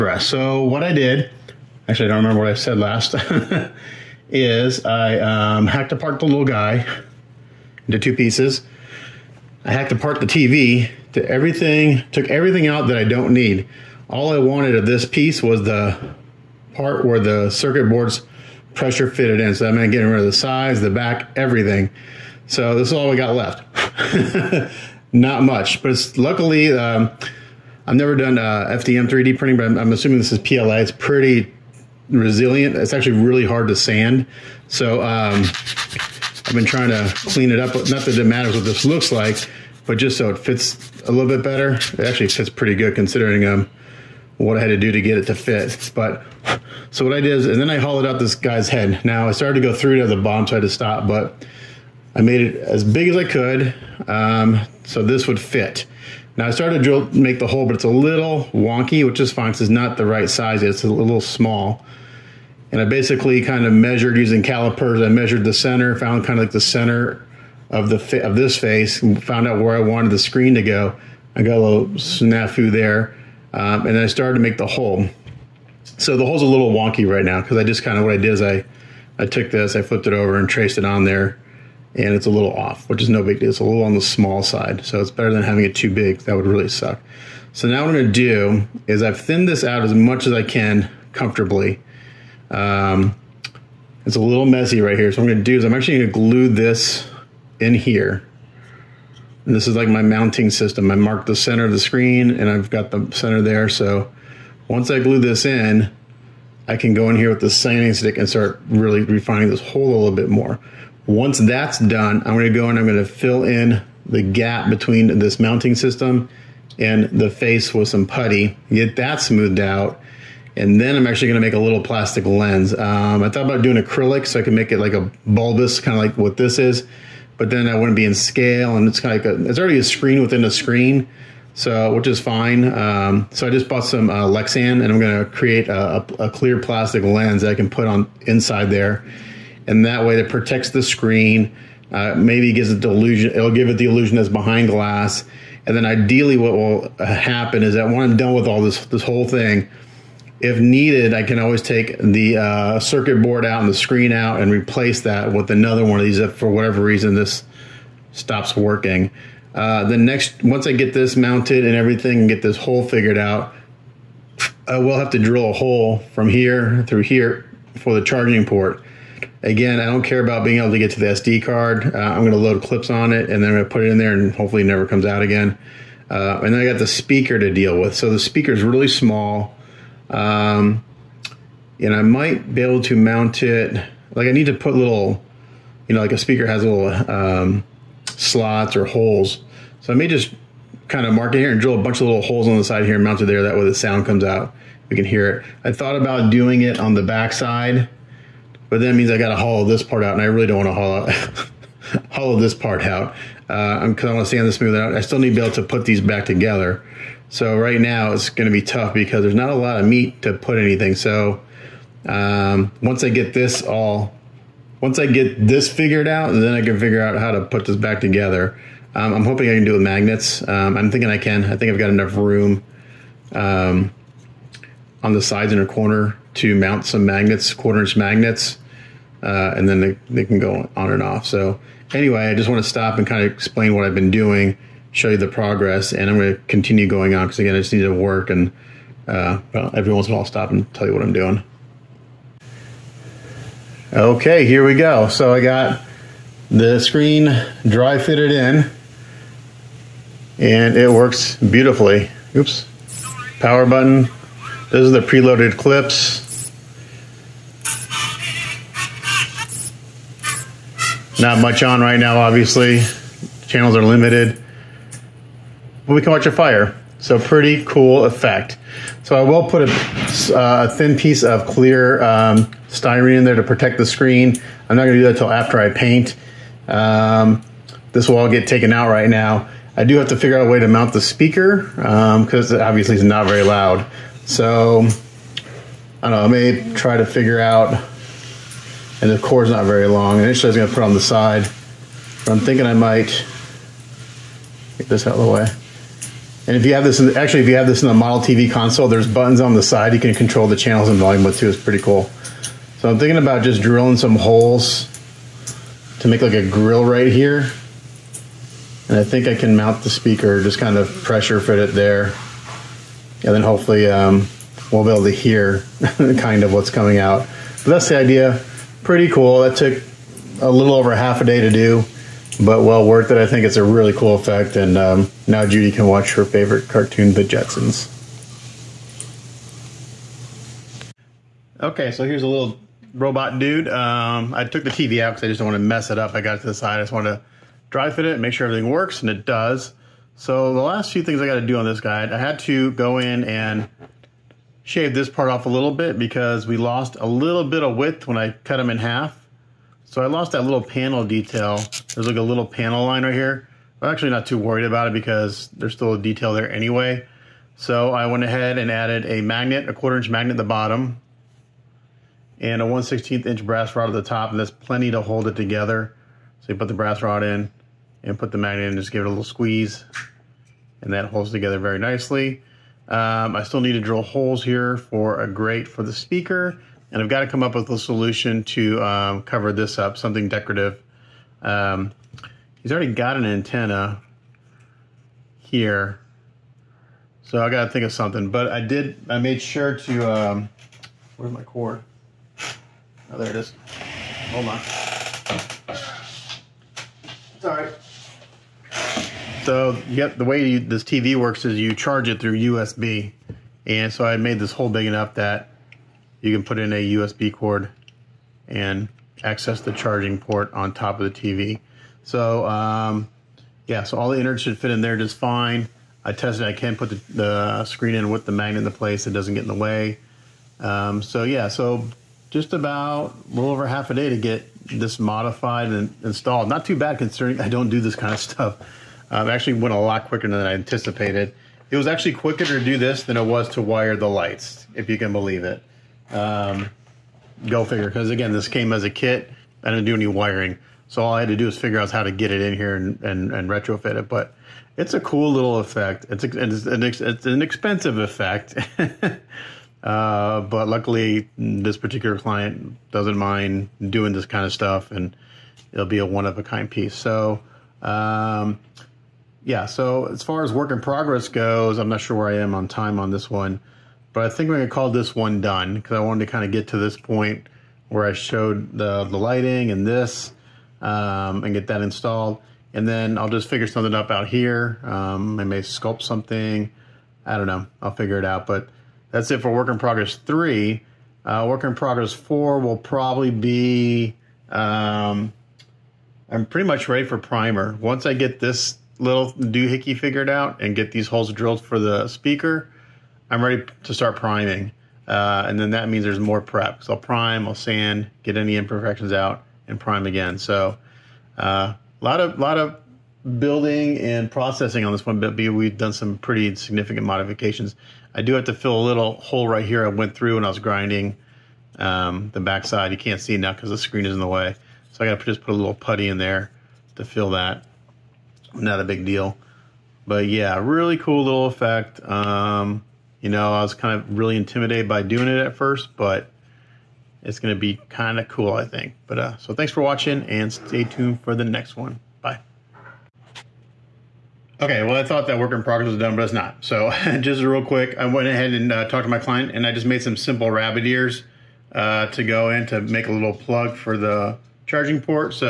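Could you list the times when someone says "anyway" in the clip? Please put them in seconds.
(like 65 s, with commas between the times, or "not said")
231 s, 356 s.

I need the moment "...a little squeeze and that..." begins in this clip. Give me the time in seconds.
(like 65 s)
369 s.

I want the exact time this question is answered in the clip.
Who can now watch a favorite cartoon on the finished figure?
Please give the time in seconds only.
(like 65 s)
325 s.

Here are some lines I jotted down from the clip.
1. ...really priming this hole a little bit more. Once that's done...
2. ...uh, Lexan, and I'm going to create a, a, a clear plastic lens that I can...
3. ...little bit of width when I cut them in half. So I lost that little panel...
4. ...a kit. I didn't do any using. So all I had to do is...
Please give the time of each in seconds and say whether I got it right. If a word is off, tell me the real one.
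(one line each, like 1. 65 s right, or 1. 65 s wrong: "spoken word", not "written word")
1. 108 s wrong: "refining", not "priming"
2. 134 s right
3. 347 s right
4. 438 s wrong: "wiring", not "using".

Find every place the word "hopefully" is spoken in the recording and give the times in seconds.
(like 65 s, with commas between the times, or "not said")
174 s, 313 s.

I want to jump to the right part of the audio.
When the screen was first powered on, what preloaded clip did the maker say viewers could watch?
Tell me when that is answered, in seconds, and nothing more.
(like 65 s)
266 s.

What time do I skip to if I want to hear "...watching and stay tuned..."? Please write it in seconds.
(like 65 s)
529 s.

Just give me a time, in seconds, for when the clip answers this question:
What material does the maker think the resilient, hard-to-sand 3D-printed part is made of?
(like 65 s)
30 s.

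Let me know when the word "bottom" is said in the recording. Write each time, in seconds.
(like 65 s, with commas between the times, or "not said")
50 s, 360 s.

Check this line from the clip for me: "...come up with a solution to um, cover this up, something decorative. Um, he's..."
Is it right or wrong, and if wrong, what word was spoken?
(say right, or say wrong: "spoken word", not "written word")
right.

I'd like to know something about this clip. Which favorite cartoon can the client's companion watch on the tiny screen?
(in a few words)
The Jetsons.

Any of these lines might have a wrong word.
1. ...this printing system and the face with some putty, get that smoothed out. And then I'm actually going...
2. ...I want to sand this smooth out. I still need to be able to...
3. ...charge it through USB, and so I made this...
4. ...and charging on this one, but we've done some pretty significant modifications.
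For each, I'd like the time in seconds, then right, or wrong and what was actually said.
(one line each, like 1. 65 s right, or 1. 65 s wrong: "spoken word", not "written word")
1. 115 s wrong: "mounting", not "printing"
2. 204 s right
3. 401 s right
4. 503 s wrong: "processing", not "charging".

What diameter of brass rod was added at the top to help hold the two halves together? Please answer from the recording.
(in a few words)
1/16 inch.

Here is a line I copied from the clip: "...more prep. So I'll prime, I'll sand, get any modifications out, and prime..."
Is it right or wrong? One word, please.
wrong.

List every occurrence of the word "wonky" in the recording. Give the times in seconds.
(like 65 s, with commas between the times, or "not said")
58 s, 76 s.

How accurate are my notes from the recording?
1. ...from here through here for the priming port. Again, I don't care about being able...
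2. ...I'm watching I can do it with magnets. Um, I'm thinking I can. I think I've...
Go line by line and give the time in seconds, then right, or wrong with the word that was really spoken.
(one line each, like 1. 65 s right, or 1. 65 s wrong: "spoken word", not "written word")
1. 166 s wrong: "charging", not "priming"
2. 219 s wrong: "hoping", not "watching".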